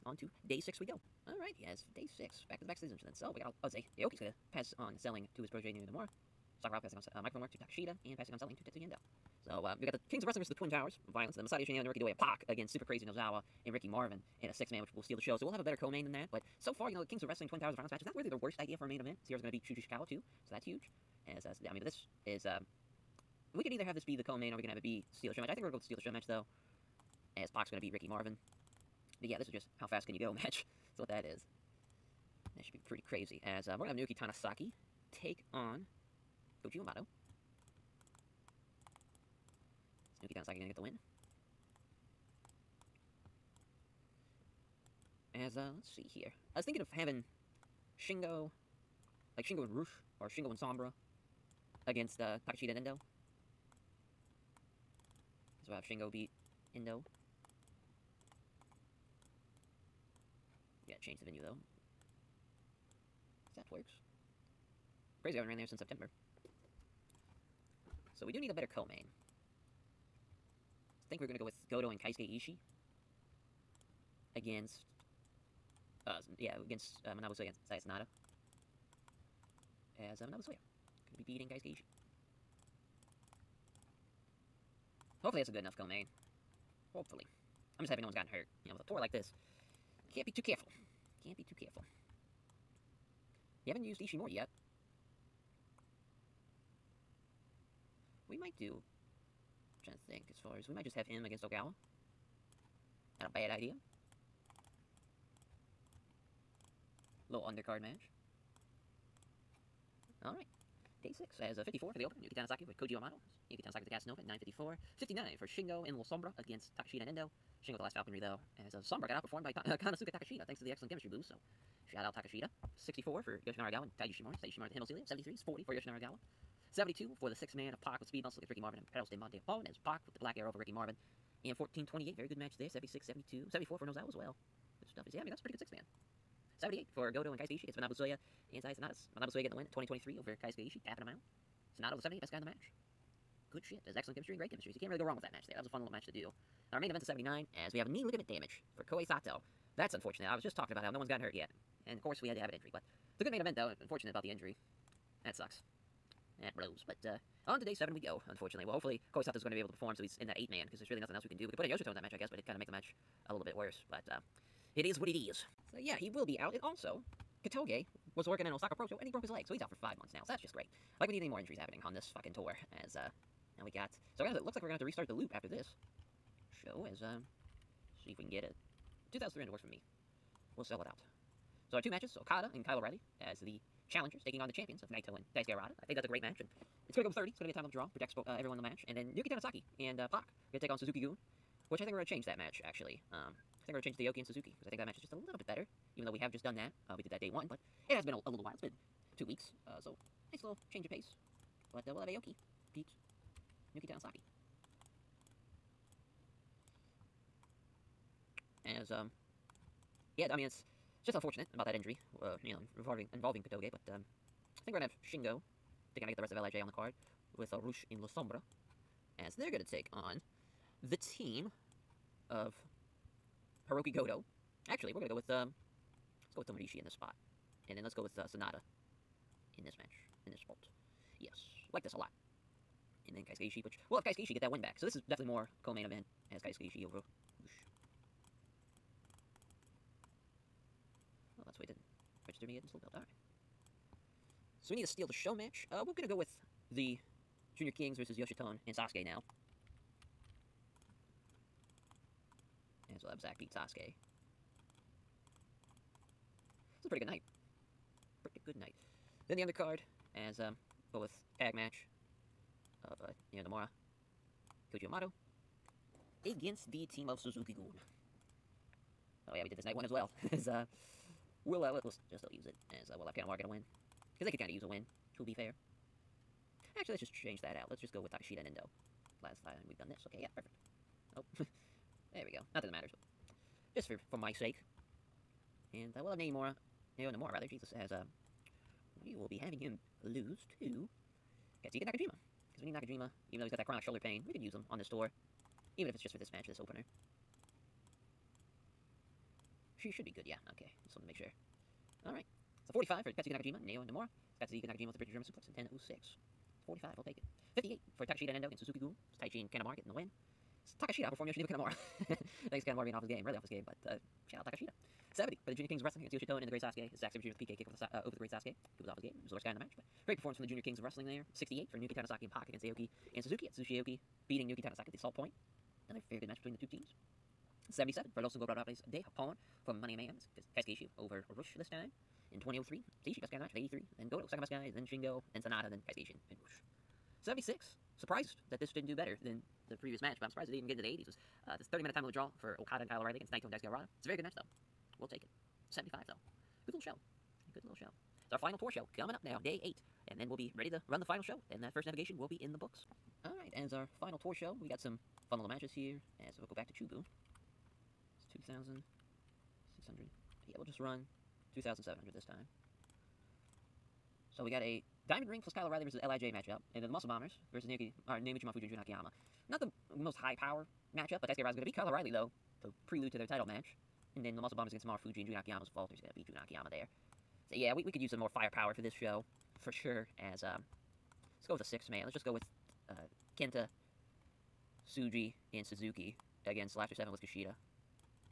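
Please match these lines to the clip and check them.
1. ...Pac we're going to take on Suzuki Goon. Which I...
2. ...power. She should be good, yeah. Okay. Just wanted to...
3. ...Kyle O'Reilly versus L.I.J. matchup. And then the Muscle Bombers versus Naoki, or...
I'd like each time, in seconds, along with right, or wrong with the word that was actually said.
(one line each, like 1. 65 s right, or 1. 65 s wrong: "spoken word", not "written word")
1. 190 s right
2. 296 s wrong: "opener", not "power"
3. 365 s right.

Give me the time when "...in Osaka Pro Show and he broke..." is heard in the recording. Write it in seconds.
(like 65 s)
168 s.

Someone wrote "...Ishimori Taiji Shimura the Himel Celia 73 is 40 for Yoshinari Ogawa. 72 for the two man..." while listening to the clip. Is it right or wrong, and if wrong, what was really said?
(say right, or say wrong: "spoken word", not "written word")
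wrong: "six", not "two".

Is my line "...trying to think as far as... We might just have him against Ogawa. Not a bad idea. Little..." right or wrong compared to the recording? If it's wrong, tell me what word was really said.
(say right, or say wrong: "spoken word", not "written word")
right.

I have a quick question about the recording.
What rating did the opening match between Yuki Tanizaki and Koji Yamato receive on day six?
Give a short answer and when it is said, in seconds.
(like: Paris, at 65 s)
54, at 111 s.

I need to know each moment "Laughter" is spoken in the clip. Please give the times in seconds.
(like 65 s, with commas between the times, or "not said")
386 s.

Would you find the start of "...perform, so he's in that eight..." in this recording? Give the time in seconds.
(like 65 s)
159 s.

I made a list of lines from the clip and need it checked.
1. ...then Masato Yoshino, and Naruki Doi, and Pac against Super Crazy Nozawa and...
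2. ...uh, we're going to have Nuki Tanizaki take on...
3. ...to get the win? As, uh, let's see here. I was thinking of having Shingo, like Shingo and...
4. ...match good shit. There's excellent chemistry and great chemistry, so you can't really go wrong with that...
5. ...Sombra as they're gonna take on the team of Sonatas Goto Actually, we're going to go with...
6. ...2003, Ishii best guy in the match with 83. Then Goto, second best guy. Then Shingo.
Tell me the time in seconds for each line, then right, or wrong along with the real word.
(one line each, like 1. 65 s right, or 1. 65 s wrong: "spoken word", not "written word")
1. 11 s right
2. 33 s right
3. 40 s right
4. 142 s right
5. 218 s wrong: "Hirooki", not "Sonatas"
6. 332 s right.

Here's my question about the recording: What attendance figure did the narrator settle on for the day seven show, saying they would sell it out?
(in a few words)
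2,300.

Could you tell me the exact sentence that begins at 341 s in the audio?
was uh, this 30 minute time limit draw for Okada and Kyle O'Reilly against Naito and Daisuke Harada.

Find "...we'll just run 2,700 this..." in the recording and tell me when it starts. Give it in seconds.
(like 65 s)
360 s.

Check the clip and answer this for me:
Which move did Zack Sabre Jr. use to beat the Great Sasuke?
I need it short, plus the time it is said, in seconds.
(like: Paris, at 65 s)
PK kick, at 317 s.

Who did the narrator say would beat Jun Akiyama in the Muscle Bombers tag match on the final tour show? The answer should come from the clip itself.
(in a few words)
Walter.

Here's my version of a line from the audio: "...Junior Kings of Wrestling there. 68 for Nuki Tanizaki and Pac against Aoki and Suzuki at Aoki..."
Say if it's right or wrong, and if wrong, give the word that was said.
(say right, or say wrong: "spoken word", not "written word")
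right.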